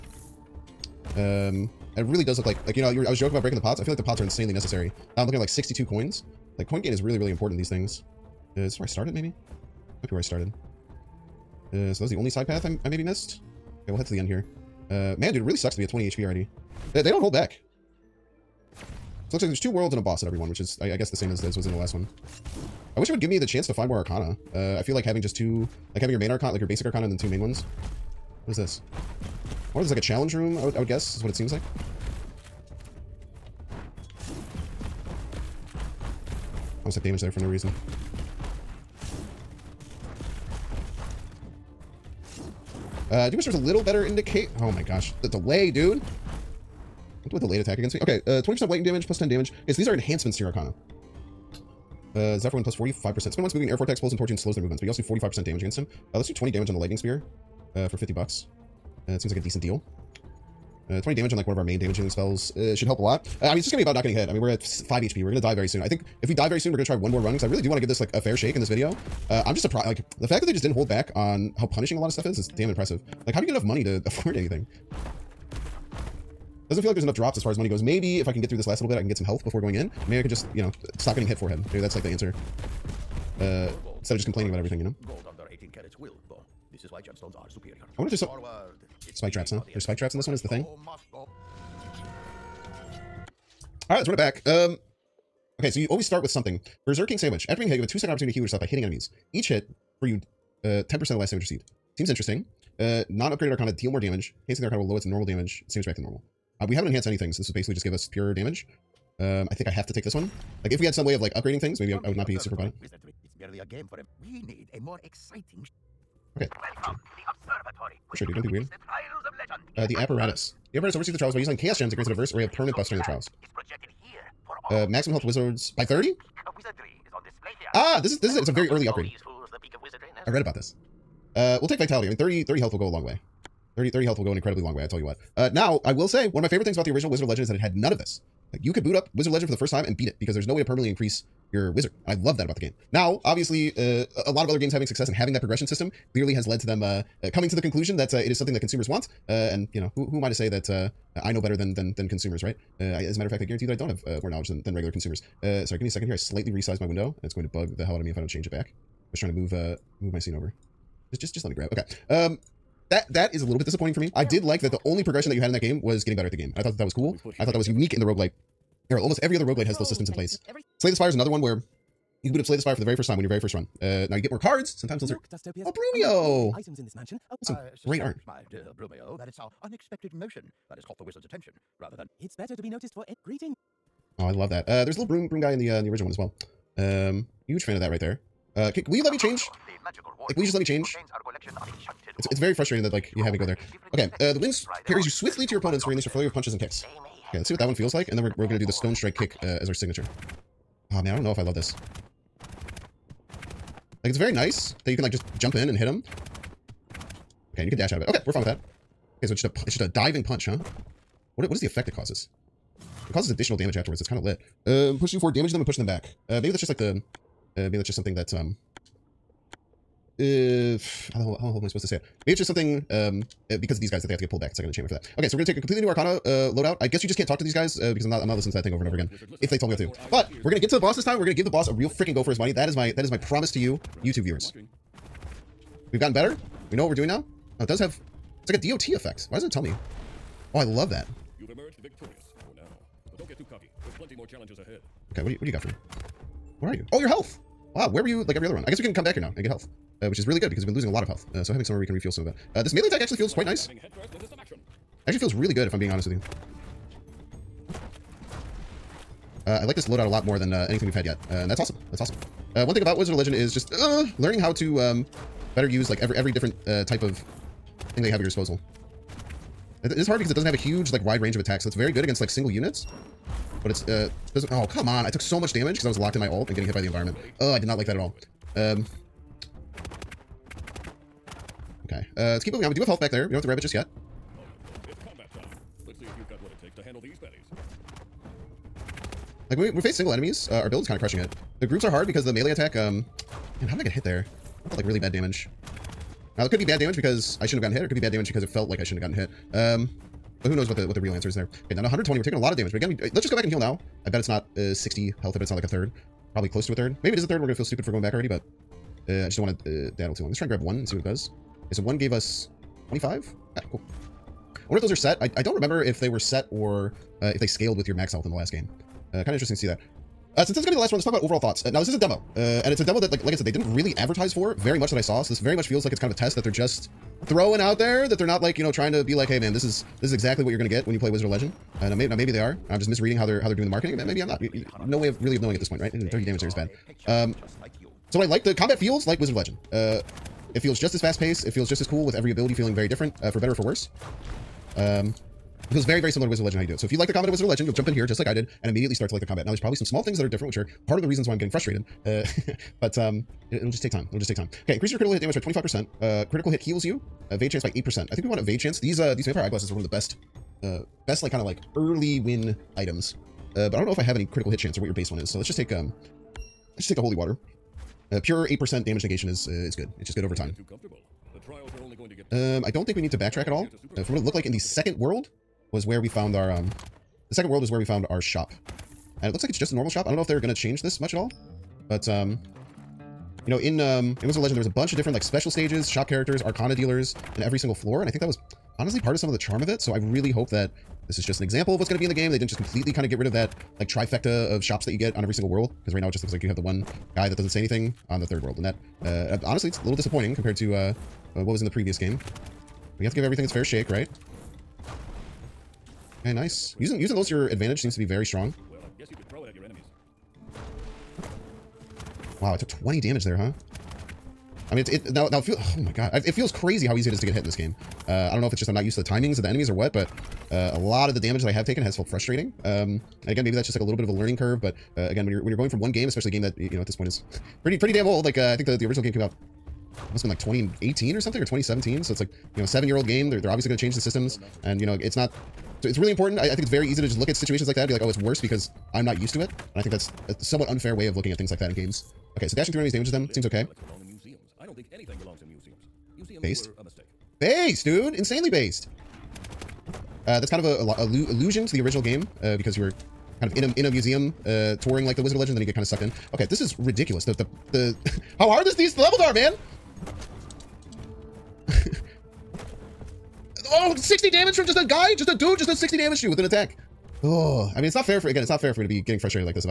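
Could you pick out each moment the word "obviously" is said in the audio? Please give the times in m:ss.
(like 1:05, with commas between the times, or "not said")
2:23, 7:13.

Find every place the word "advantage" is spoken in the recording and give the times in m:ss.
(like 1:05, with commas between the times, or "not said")
6:47.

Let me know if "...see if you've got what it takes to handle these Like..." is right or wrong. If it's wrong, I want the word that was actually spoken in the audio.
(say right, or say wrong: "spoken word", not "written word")
right.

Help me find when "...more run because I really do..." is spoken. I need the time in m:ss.
1:07.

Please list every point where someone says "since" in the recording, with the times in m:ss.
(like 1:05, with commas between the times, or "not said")
5:20.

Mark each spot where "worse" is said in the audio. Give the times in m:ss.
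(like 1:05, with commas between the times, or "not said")
5:43, 7:18.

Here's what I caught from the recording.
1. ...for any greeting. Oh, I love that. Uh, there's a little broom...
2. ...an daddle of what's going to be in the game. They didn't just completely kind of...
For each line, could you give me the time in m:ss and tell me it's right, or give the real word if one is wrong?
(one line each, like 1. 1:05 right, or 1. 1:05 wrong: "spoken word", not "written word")
1. 3:02 right
2. 6:31 wrong: "example", not "daddle".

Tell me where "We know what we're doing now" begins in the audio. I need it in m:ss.
3:56.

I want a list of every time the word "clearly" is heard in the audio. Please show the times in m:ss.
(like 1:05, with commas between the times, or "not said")
2:26.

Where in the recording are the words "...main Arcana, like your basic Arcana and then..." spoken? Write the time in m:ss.
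0:26.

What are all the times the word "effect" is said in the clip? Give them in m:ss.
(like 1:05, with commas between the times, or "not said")
3:31, 3:58.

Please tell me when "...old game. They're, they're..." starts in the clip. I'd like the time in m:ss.
7:12.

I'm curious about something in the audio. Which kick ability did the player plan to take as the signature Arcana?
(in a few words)
stone strike kick.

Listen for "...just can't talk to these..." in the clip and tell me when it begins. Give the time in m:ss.
3:47.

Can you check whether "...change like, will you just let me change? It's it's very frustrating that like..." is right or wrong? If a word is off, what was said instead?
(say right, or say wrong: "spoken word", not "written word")
right.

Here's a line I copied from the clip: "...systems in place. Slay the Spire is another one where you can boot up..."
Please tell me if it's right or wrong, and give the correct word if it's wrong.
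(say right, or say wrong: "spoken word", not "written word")
right.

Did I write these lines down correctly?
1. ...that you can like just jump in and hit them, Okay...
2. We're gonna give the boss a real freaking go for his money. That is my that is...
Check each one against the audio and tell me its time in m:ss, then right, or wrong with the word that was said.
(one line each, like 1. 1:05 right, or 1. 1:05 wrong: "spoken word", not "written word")
1. 3:24 right
2. 3:51 right.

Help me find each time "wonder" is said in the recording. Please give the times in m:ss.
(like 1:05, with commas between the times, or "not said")
1:27, 5:14.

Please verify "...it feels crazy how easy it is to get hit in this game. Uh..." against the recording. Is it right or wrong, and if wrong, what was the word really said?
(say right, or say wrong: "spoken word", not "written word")
right.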